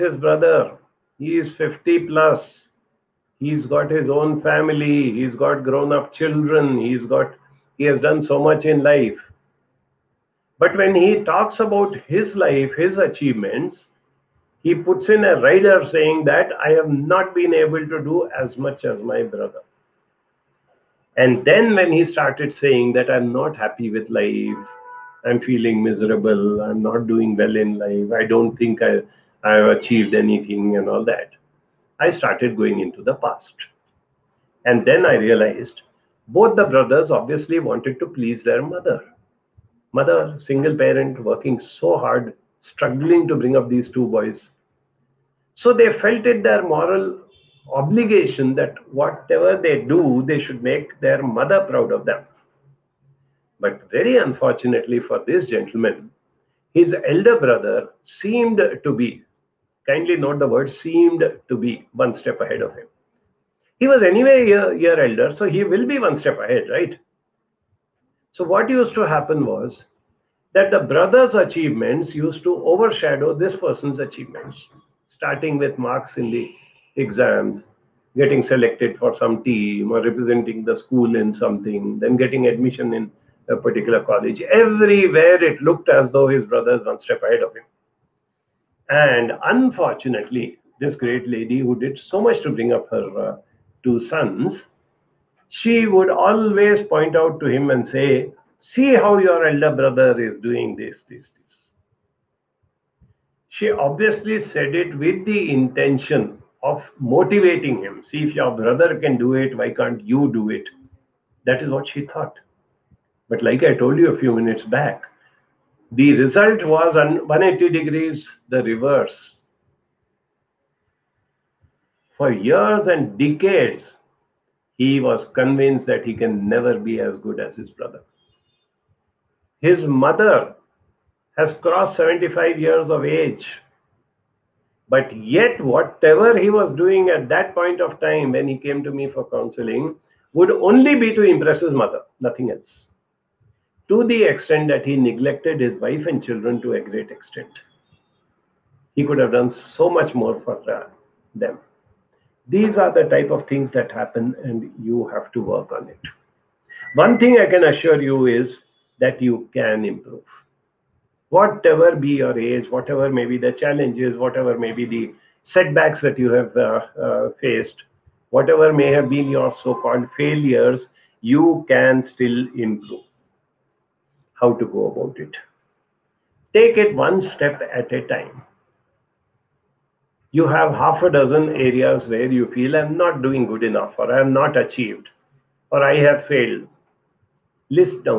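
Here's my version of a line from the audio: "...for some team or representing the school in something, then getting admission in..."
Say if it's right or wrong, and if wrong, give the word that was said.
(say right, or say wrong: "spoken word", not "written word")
right.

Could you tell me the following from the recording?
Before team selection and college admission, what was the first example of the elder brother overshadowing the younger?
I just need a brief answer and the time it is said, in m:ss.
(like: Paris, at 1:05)
marks in the exams, at 1:15.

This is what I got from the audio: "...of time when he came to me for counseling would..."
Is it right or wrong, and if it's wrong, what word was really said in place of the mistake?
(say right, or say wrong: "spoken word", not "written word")
right.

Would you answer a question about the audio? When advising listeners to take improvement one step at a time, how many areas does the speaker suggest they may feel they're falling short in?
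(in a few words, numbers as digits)
half a dozen.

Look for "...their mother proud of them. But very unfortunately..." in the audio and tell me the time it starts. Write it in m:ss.
0:50.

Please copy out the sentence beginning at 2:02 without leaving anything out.
For years and decades, he was convinced that he can never be as good as his brother.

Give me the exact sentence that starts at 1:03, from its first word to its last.
He was anyway a year, elder, so he will be one step ahead, right?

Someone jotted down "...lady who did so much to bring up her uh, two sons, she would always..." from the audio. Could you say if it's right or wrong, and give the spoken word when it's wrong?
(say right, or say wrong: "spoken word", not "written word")
right.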